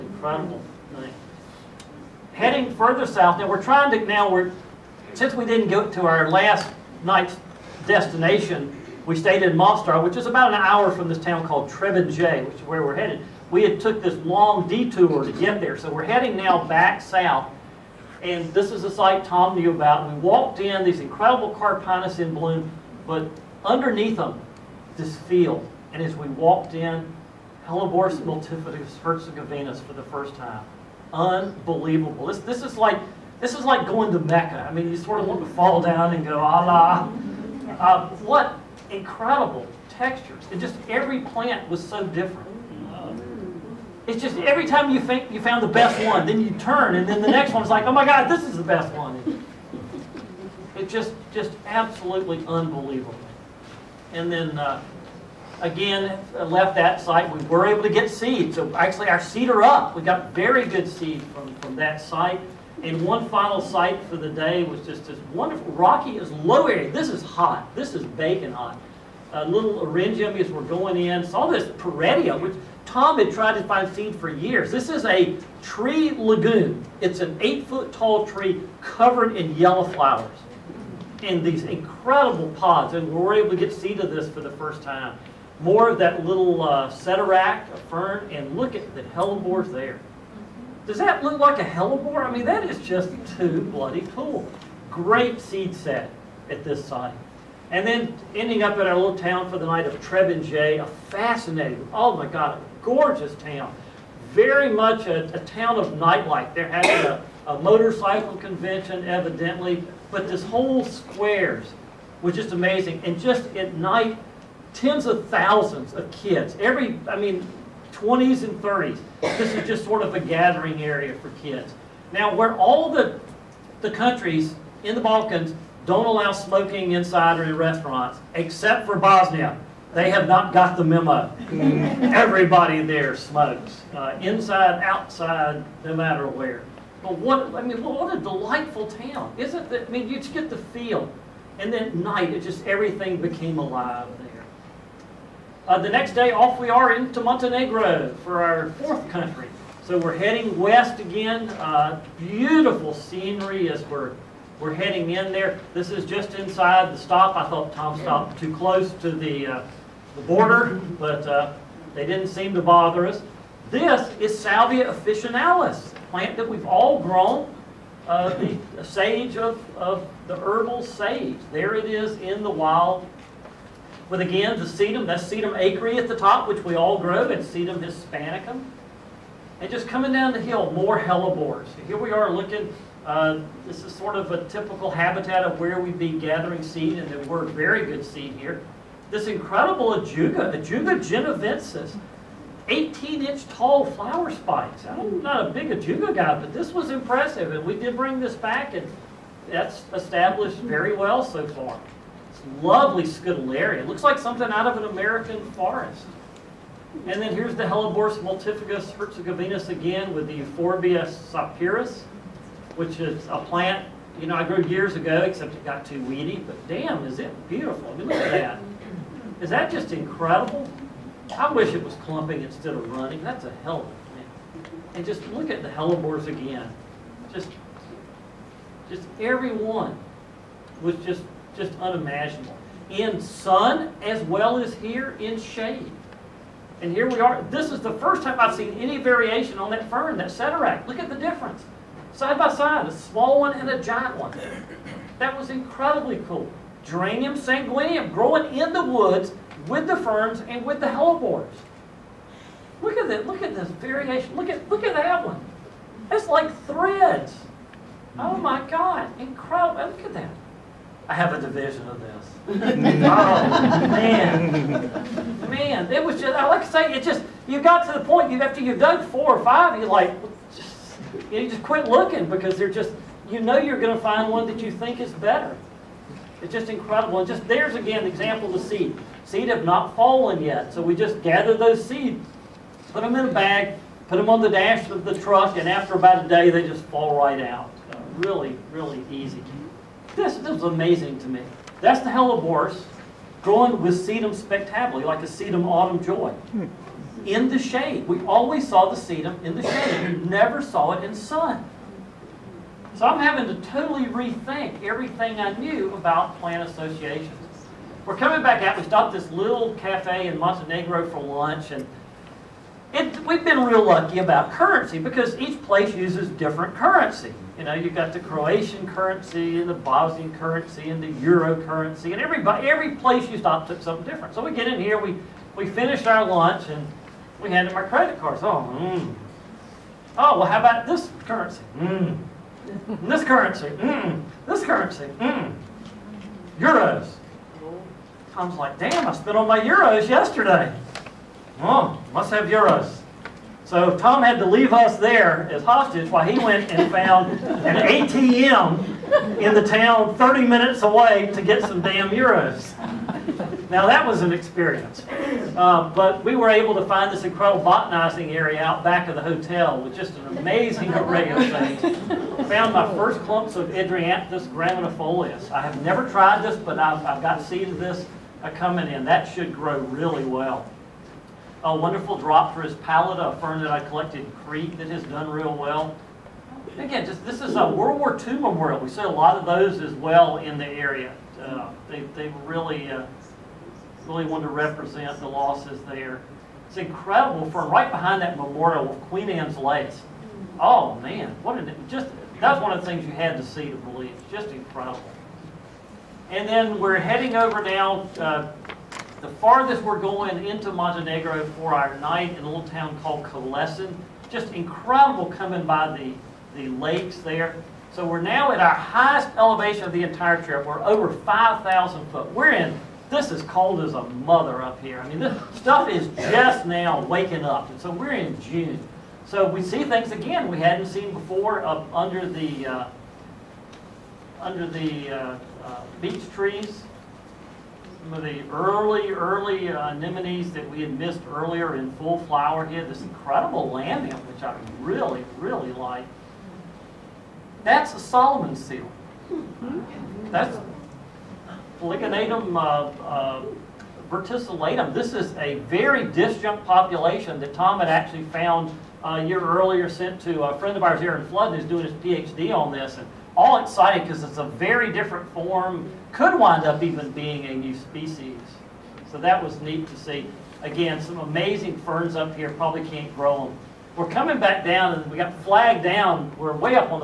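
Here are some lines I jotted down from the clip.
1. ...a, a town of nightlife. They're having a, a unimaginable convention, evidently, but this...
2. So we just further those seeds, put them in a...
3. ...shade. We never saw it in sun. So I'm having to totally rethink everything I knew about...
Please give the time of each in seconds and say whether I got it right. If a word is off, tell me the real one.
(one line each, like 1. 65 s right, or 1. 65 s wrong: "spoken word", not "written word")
1. 105 s wrong: "motorcycle", not "unimaginable"
2. 280 s wrong: "gather", not "further"
3. 299 s right.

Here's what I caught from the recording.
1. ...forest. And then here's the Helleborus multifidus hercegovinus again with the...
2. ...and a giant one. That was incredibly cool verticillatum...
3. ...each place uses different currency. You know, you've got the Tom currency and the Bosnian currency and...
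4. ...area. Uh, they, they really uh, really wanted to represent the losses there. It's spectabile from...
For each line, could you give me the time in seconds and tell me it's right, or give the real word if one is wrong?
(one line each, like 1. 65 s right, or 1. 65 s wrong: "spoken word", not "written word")
1. 205 s right
2. 243 s wrong: "geranium", not "verticillatum"
3. 315 s wrong: "Croatian", not "Tom"
4. 380 s wrong: "incredible", not "spectabile".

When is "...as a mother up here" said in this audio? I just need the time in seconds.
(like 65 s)
413 s.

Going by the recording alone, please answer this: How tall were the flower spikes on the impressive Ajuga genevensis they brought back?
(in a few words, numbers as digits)
18 inches.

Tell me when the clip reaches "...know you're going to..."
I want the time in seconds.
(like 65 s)
273 s.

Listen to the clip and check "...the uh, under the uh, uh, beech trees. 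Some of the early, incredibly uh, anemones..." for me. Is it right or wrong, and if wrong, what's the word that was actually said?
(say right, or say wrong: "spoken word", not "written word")
wrong: "early", not "incredibly".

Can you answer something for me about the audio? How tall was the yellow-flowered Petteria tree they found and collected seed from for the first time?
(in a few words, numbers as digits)
8 feet.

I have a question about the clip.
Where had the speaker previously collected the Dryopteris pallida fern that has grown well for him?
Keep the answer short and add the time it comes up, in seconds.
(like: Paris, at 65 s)
Crete, at 374 s.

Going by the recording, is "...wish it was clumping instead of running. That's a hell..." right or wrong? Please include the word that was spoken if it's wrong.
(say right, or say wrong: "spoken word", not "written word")
right.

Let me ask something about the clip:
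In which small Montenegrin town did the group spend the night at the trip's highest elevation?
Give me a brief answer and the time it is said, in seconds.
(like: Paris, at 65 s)
Kolašin, at 403 s.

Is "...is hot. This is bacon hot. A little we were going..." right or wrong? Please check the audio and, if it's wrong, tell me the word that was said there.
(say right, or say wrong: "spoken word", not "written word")
right.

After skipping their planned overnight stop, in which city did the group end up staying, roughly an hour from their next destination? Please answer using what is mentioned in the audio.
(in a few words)
Mostar.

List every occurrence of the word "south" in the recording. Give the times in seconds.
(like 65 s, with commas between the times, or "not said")
3 s, 17 s.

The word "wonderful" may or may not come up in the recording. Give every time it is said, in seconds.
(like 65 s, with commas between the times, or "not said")
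65 s, 371 s.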